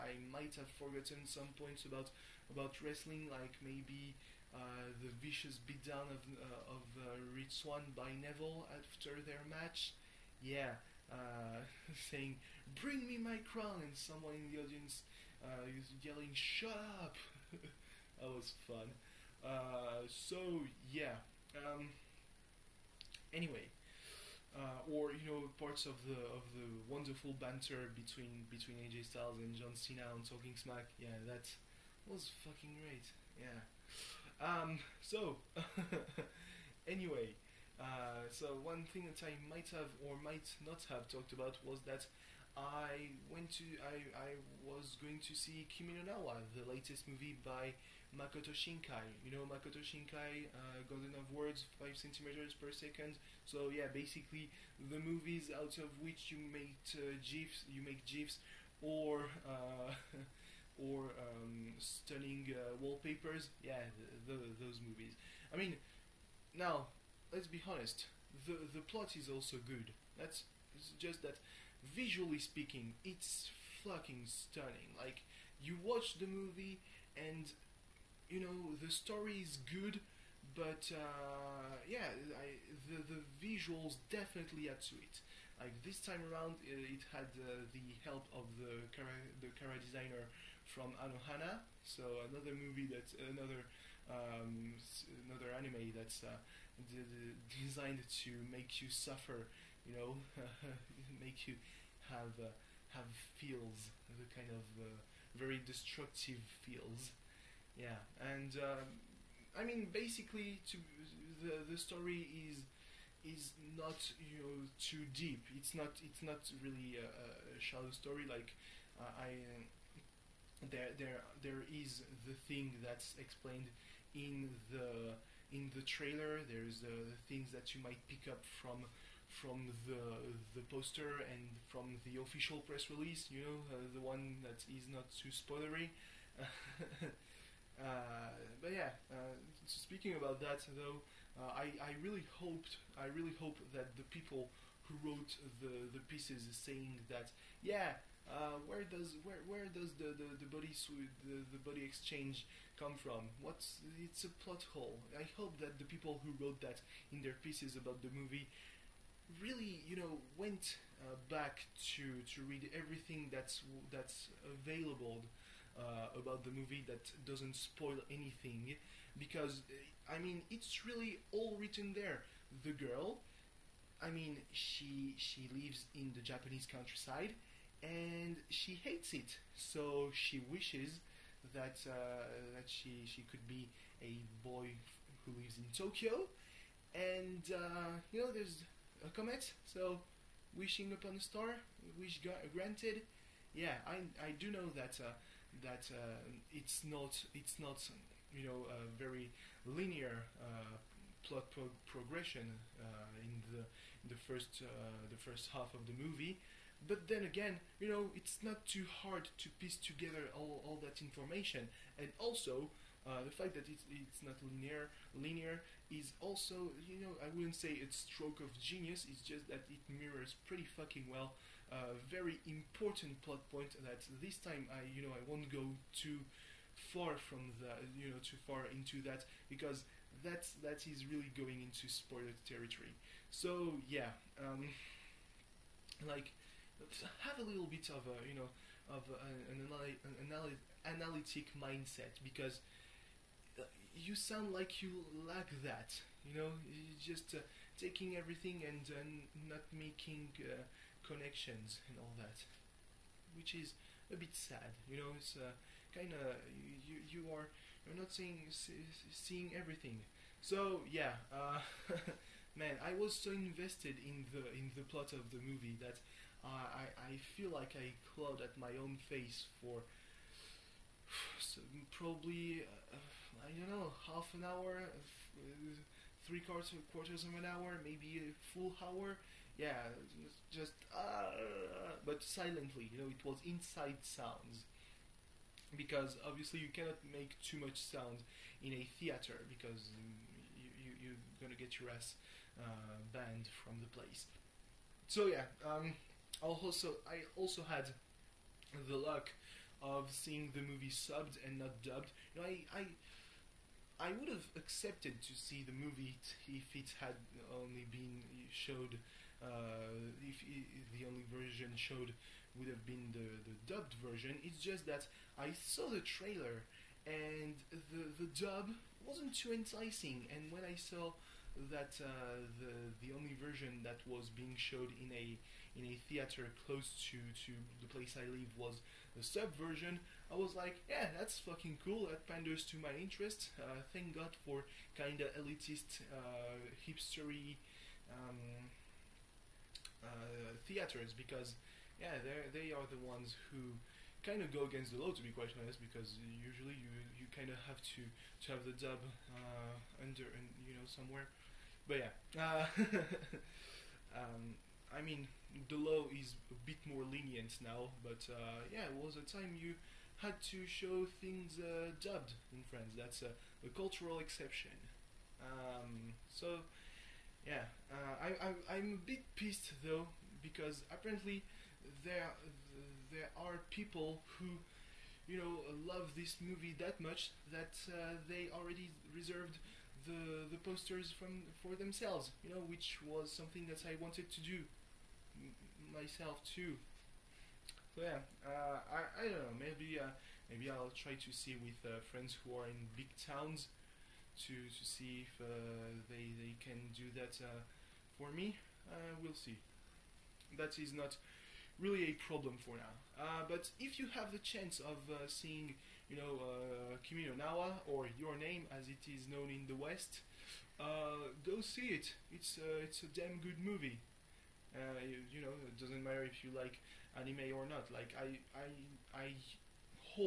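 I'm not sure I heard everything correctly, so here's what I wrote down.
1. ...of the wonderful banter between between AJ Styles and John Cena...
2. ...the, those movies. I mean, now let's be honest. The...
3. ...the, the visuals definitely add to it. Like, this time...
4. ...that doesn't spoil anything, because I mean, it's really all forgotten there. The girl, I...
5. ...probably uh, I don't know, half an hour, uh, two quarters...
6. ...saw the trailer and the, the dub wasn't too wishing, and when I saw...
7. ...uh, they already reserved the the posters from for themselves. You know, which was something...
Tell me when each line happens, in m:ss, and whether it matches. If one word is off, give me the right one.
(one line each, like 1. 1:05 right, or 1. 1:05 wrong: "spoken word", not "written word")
1. 0:26 right
2. 1:04 right
3. 1:22 right
4. 2:46 wrong: "written", not "forgotten"
5. 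4:31 wrong: "three", not "two"
6. 5:15 wrong: "enticing", not "wishing"
7. 6:17 right.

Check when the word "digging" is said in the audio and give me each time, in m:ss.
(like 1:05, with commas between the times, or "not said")
not said.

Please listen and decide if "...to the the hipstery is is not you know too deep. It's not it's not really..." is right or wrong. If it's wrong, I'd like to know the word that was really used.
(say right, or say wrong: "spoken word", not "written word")
wrong: "story", not "hipstery".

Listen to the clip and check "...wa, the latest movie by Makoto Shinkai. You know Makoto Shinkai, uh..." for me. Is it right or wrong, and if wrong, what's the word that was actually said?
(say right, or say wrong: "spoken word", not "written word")
right.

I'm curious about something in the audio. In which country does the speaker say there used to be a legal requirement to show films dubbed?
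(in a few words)
France.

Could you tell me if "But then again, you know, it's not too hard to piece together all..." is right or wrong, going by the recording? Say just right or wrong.
right.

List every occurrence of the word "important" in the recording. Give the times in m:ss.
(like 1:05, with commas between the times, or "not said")
3:42.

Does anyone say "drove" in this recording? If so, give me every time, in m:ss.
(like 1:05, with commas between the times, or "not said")
not said.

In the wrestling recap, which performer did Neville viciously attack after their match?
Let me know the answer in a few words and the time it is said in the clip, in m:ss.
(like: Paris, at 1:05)
Rich Swann, at 0:07.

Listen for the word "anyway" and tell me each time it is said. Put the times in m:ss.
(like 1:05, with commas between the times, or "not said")
0:23, 0:36.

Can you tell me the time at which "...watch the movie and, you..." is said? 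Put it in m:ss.
1:15.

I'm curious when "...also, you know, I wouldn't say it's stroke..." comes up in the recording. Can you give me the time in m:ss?
3:36.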